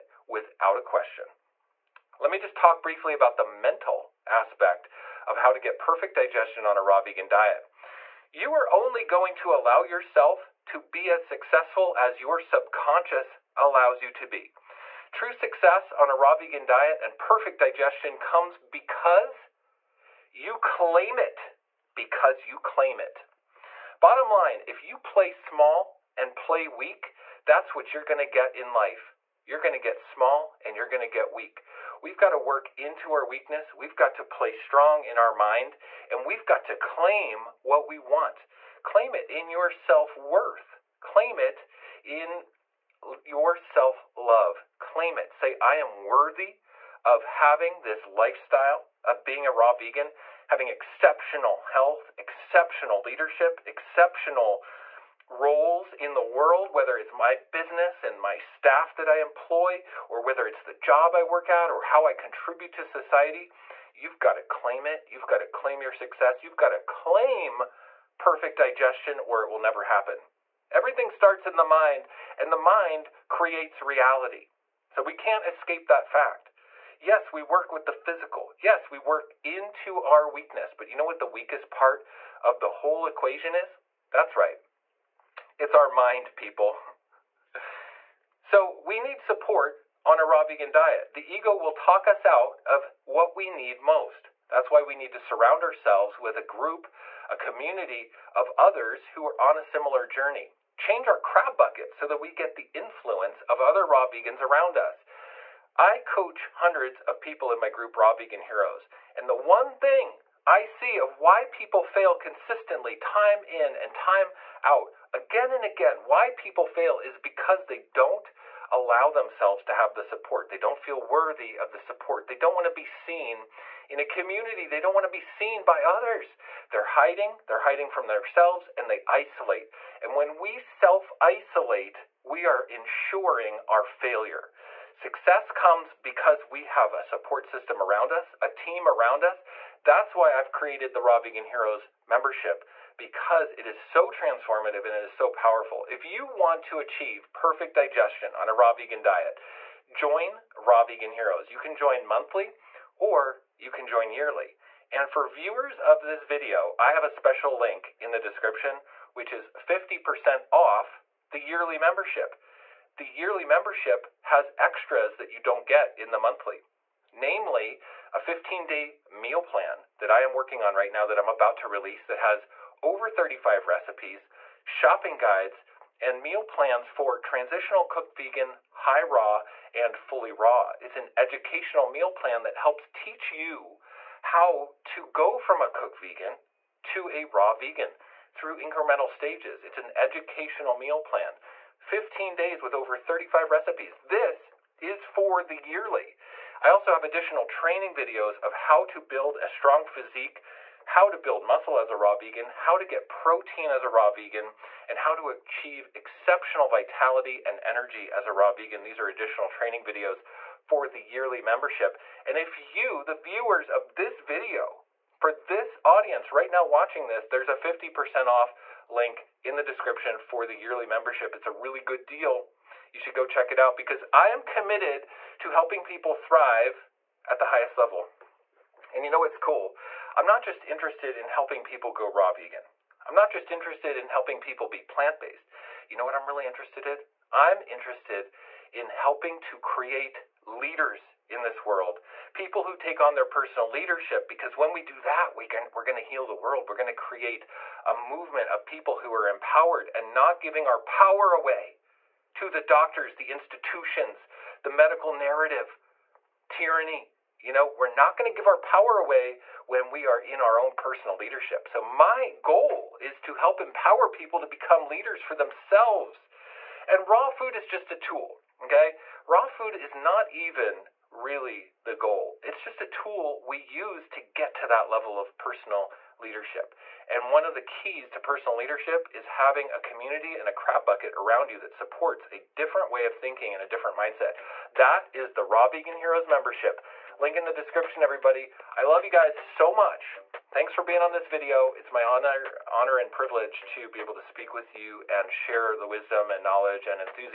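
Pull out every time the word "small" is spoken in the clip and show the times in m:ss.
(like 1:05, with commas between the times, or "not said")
0:25, 0:29.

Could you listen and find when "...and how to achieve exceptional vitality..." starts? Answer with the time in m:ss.
3:24.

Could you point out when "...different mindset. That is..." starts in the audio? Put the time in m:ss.
4:43.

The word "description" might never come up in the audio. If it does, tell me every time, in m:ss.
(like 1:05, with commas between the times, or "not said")
2:38, 3:39, 4:47.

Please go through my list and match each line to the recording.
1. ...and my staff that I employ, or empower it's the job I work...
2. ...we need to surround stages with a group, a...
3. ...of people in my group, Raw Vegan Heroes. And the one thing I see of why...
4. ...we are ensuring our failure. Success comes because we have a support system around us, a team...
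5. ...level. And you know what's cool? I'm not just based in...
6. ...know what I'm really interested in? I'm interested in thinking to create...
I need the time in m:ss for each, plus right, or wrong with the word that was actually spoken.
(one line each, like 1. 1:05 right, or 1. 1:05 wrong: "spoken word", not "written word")
1. 0:58 wrong: "whether", not "empower"
2. 1:34 wrong: "ourselves", not "stages"
3. 1:47 right
4. 2:12 right
5. 3:47 wrong: "interested", not "based"
6. 3:55 wrong: "helping", not "thinking".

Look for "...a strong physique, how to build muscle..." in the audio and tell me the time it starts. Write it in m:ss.
3:19.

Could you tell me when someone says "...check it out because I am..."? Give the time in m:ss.
3:43.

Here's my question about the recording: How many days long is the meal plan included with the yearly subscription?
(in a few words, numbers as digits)
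15.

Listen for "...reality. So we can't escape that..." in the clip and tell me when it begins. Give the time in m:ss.
1:13.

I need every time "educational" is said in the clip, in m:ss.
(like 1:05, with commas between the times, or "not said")
3:01, 3:09.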